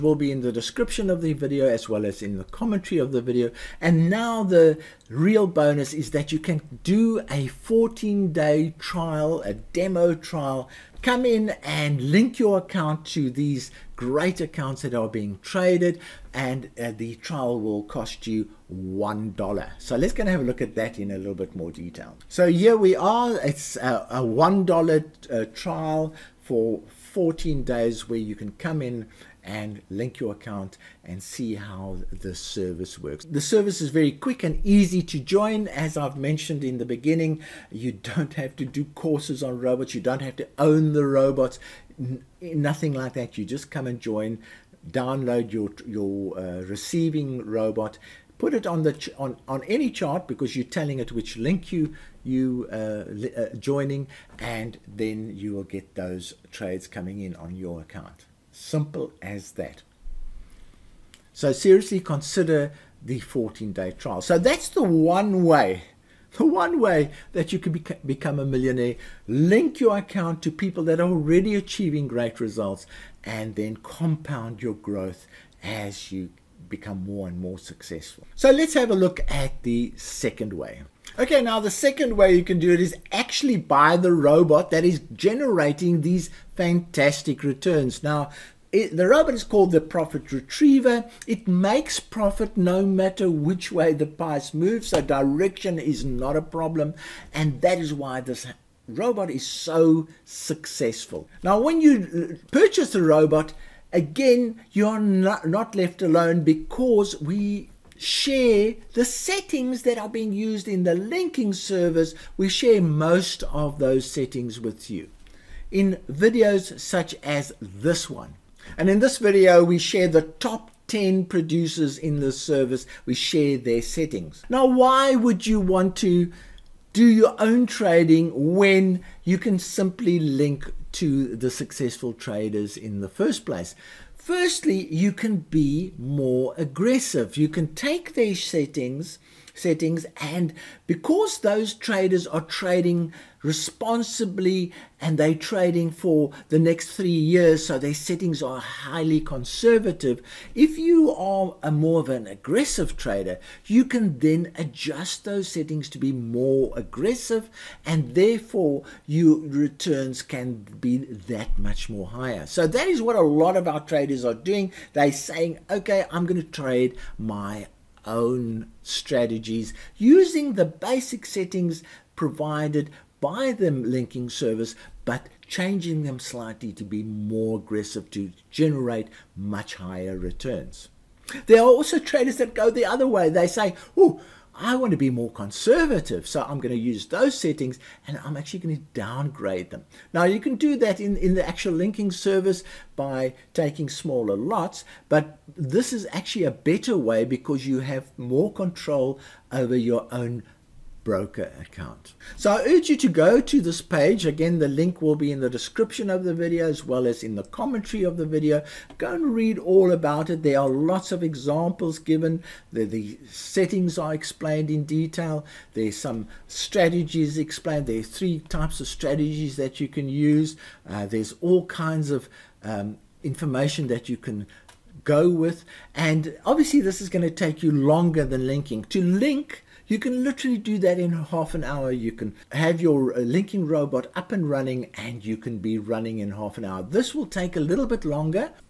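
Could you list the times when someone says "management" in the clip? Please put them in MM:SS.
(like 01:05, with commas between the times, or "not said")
not said.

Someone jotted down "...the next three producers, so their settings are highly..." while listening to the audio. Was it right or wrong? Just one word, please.
wrong.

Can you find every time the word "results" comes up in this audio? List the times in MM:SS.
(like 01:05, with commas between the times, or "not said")
01:12.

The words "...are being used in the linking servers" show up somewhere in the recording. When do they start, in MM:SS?
01:49.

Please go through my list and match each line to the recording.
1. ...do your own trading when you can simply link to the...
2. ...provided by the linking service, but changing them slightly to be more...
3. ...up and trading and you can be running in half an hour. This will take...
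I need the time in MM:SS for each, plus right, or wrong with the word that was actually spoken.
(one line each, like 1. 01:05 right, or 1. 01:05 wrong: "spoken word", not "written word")
1. 02:06 right
2. 02:52 right
3. 03:54 wrong: "running", not "trading".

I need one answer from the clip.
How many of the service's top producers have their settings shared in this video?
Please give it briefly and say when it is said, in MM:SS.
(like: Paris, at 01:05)
10, at 02:00.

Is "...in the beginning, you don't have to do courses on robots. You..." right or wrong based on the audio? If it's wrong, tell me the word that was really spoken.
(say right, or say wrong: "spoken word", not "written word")
right.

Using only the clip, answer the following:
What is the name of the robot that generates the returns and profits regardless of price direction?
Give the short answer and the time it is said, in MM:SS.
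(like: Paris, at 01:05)
Profit Retriever, at 01:29.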